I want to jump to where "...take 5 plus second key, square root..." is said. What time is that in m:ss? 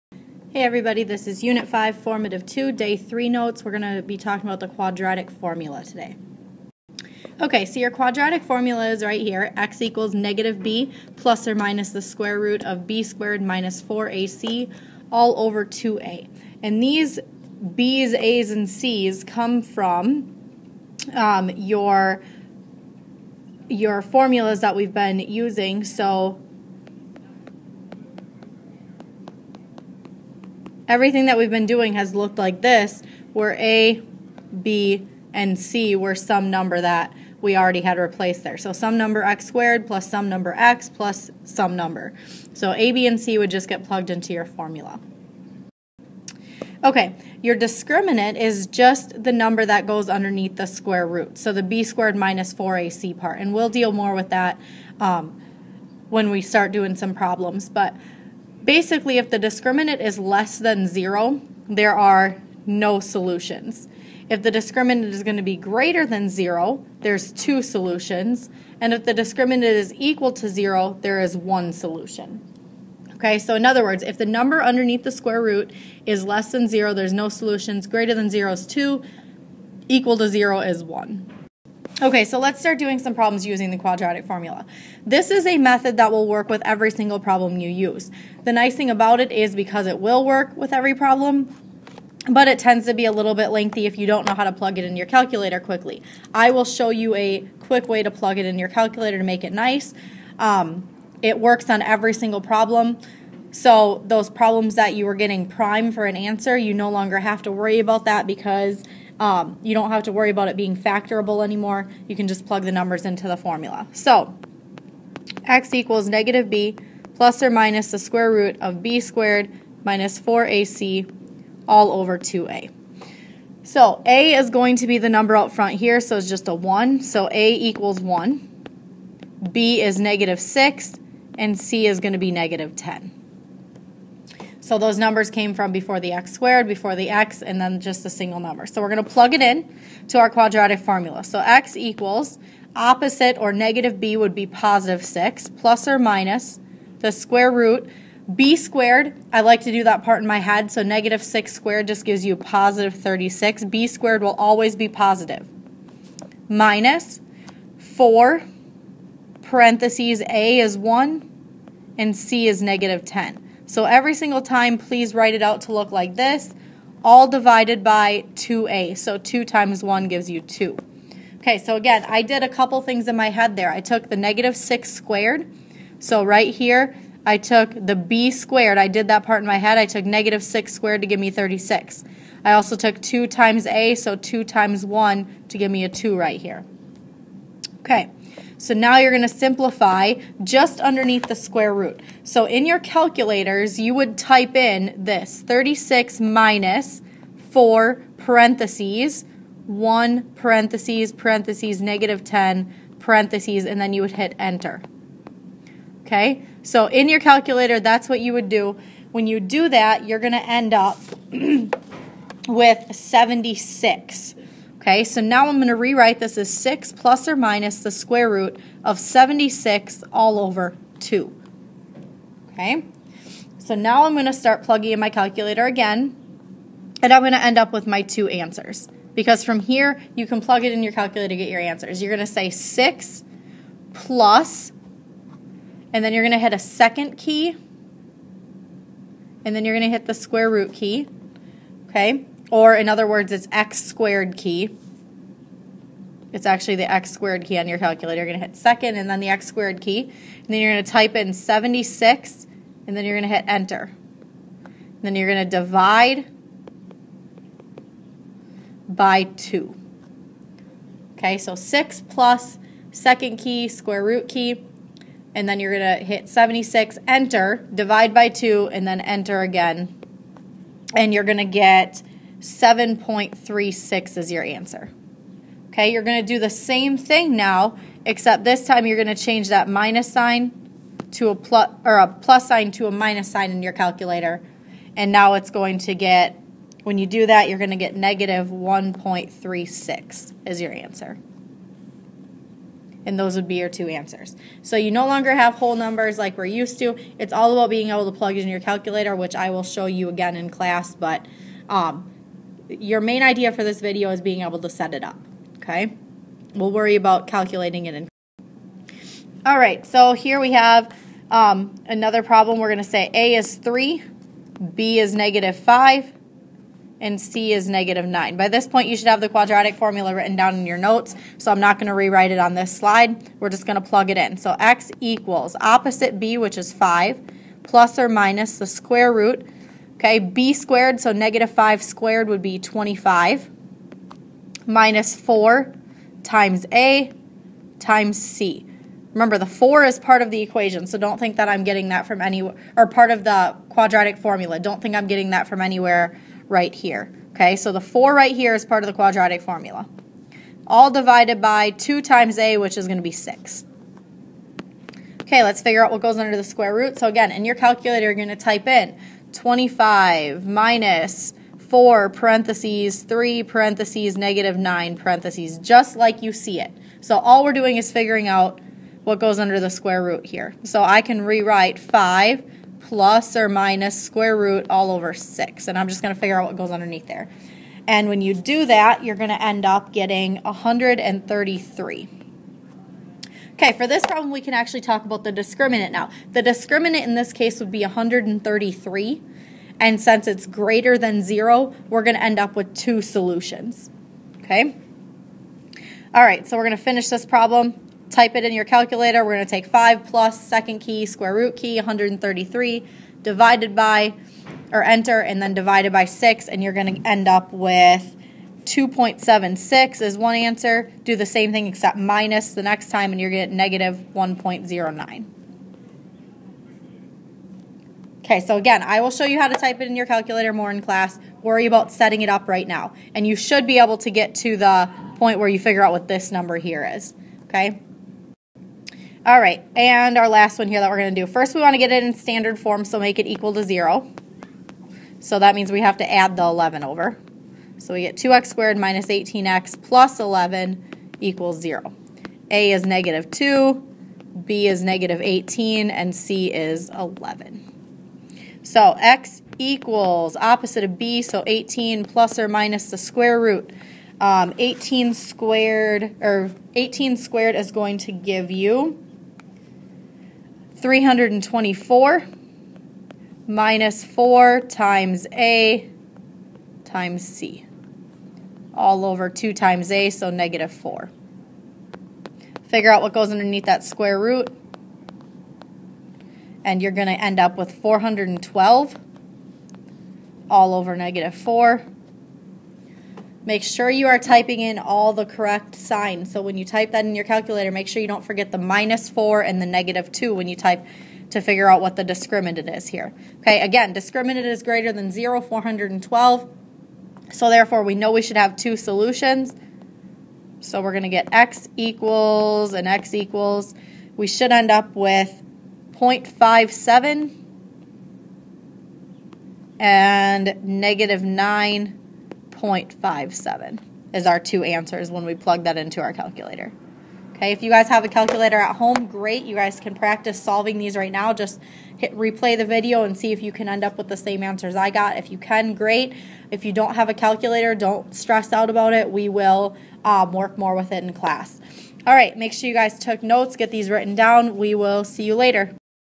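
6:39.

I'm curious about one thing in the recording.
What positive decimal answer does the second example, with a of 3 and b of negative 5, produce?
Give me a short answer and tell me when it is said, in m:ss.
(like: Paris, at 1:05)
2.76, at 6:48.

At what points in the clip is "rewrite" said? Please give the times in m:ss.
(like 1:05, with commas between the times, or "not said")
3:35, 5:21, 6:11.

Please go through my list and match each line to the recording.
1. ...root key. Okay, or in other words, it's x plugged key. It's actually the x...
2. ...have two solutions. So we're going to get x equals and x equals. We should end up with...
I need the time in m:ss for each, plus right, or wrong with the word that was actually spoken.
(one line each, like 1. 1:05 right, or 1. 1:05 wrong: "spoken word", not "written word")
1. 4:00 wrong: "squared", not "plugged"
2. 8:18 right.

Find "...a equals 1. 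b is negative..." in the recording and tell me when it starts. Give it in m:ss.
2:07.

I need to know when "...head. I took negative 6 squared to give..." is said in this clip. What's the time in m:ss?
2:59.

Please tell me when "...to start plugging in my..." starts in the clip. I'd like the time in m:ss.
3:44.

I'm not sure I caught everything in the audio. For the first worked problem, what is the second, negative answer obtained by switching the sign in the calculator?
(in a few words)
-1.36.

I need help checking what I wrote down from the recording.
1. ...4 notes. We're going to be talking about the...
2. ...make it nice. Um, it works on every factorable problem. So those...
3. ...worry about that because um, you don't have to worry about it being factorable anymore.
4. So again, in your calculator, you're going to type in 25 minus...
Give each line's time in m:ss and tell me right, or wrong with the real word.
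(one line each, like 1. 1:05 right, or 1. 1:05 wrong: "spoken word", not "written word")
1. 0:02 wrong: "3", not "4"
2. 1:39 wrong: "single", not "factorable"
3. 1:47 right
4. 5:56 right.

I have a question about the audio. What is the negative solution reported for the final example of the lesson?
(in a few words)
-9.57.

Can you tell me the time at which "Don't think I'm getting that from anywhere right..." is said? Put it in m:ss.
5:44.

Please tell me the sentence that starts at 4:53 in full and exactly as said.
And those would be your two answers.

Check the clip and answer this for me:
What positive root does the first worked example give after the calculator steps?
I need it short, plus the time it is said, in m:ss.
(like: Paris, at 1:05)
7.36, at 4:32.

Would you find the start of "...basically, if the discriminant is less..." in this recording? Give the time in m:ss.
0:58.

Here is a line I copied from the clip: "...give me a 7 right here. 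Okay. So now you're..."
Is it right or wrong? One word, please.
wrong.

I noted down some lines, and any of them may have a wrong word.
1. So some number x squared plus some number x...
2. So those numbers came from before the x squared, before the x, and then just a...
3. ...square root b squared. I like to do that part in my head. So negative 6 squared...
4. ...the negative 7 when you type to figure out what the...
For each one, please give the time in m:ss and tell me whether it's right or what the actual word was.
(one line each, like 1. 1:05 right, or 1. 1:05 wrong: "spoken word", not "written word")
1. 0:38 right
2. 2:14 right
3. 2:27 right
4. 8:09 wrong: "2", not "7".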